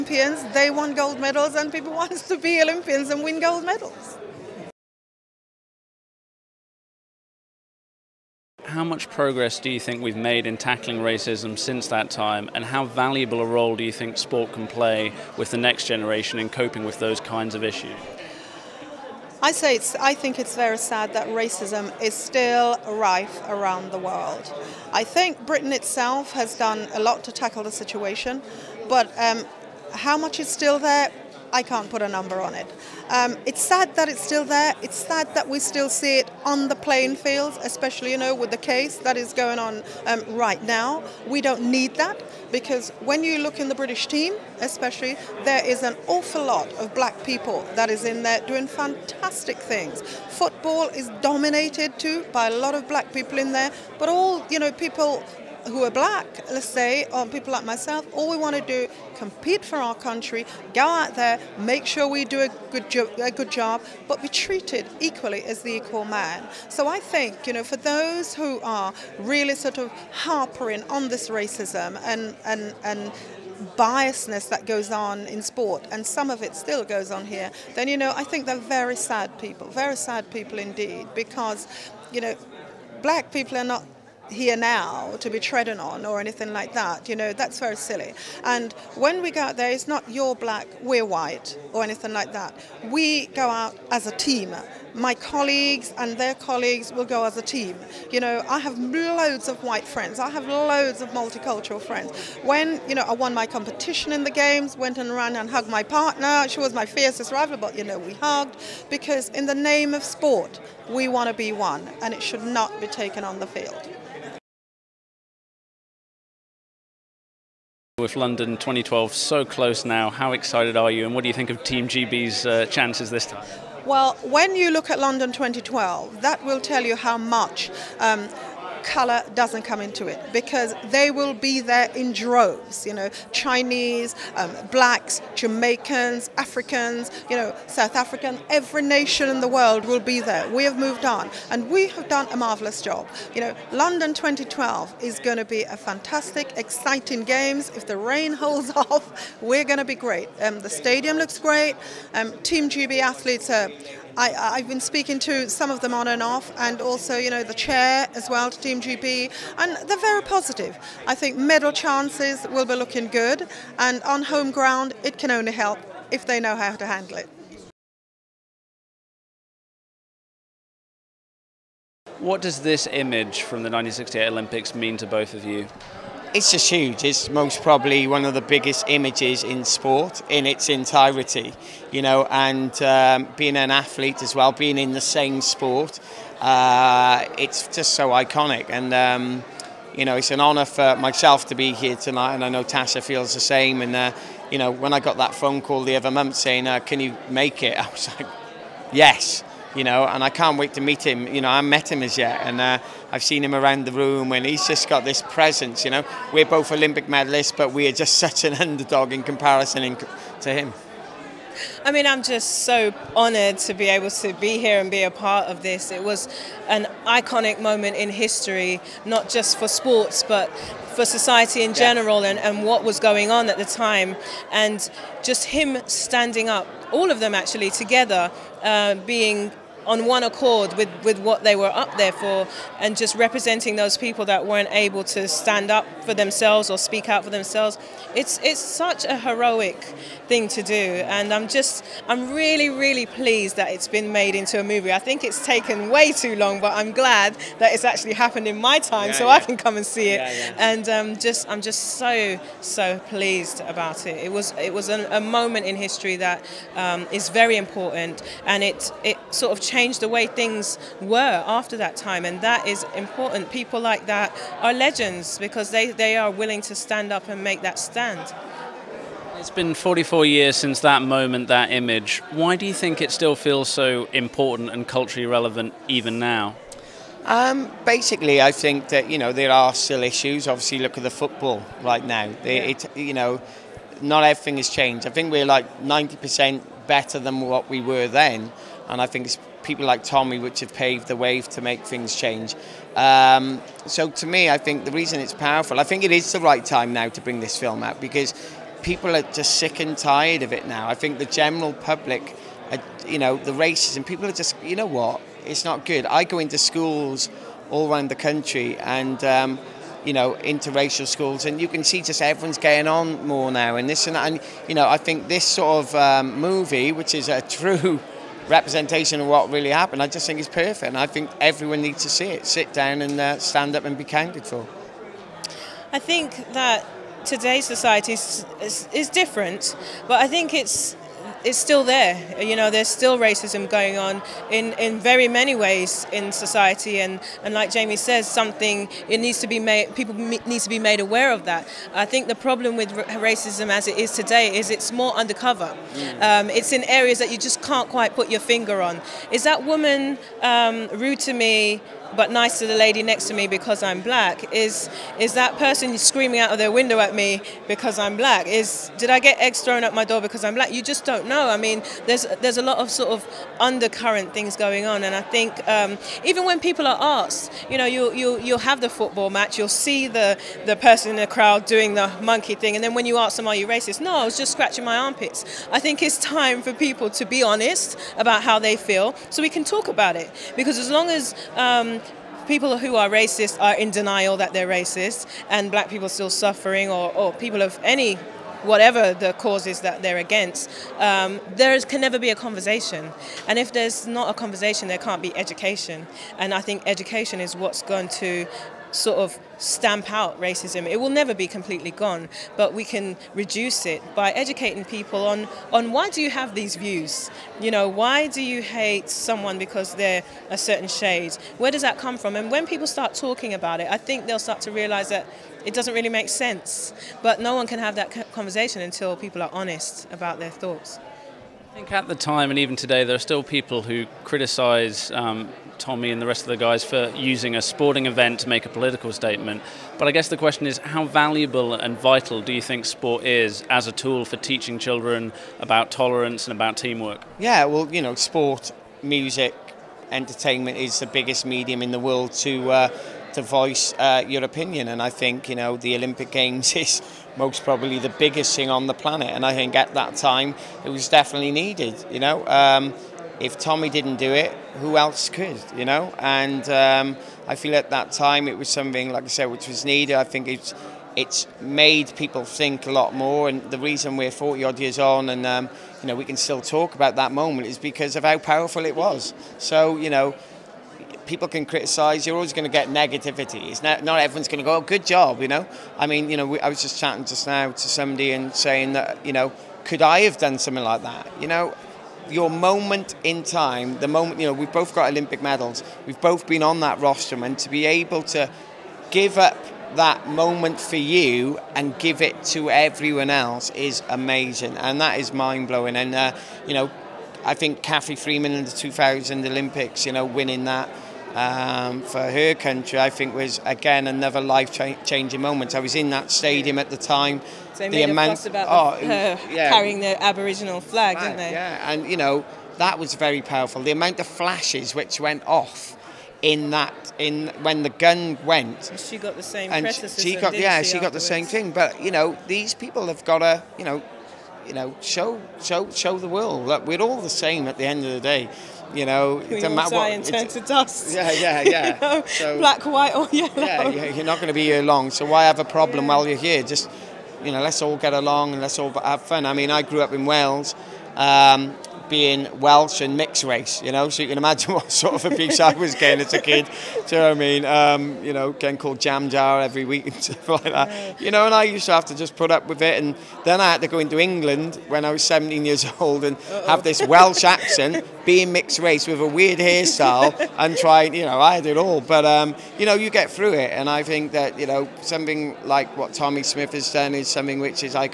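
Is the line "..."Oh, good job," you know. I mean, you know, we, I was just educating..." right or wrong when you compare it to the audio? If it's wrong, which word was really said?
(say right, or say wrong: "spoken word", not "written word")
wrong: "chatting", not "educating".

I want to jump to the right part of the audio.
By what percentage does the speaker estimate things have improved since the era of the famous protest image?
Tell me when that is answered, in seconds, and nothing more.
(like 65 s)
285 s.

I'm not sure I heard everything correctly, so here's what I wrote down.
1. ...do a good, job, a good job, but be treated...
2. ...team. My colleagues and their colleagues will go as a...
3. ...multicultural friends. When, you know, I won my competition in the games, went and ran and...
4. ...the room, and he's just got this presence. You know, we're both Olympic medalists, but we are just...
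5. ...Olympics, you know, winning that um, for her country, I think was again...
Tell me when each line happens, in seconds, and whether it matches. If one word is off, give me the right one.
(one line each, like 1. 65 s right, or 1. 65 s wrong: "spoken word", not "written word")
1. 62 s right
2. 94 s right
3. 101 s right
4. 203 s right
5. 499 s right.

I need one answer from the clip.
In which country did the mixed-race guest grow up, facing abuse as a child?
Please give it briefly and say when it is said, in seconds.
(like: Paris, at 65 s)
Wales, at 540 s.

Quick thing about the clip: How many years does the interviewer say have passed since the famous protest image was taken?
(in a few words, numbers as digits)
44.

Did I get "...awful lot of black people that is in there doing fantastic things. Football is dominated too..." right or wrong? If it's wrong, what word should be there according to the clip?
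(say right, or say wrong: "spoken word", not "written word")
right.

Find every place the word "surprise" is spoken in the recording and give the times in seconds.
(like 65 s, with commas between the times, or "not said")
not said.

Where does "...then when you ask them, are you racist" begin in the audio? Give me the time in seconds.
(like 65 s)
372 s.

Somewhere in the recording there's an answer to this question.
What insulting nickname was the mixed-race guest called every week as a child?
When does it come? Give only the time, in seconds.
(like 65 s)
549 s.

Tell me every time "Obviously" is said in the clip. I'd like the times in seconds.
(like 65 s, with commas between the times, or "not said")
280 s.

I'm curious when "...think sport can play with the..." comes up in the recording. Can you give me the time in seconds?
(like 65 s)
13 s.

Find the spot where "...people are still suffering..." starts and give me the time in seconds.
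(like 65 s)
385 s.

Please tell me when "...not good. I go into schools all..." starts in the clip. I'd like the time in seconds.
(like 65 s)
305 s.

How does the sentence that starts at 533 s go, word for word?
Yeah, you're not going to be here long.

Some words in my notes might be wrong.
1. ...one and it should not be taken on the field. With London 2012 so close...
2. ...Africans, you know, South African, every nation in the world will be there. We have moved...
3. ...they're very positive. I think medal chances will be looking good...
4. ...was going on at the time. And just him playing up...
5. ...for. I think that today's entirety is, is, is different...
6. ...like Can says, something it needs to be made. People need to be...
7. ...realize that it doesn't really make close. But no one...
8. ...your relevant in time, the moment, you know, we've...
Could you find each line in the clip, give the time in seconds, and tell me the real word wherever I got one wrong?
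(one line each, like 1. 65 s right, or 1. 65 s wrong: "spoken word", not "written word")
1. 111 s right
2. 136 s right
3. 159 s right
4. 222 s wrong: "standing", not "playing"
5. 324 s wrong: "society", not "entirety"
6. 337 s wrong: "Jamie", not "Can"
7. 414 s wrong: "sense", not "close"
8. 482 s wrong: "moment", not "relevant".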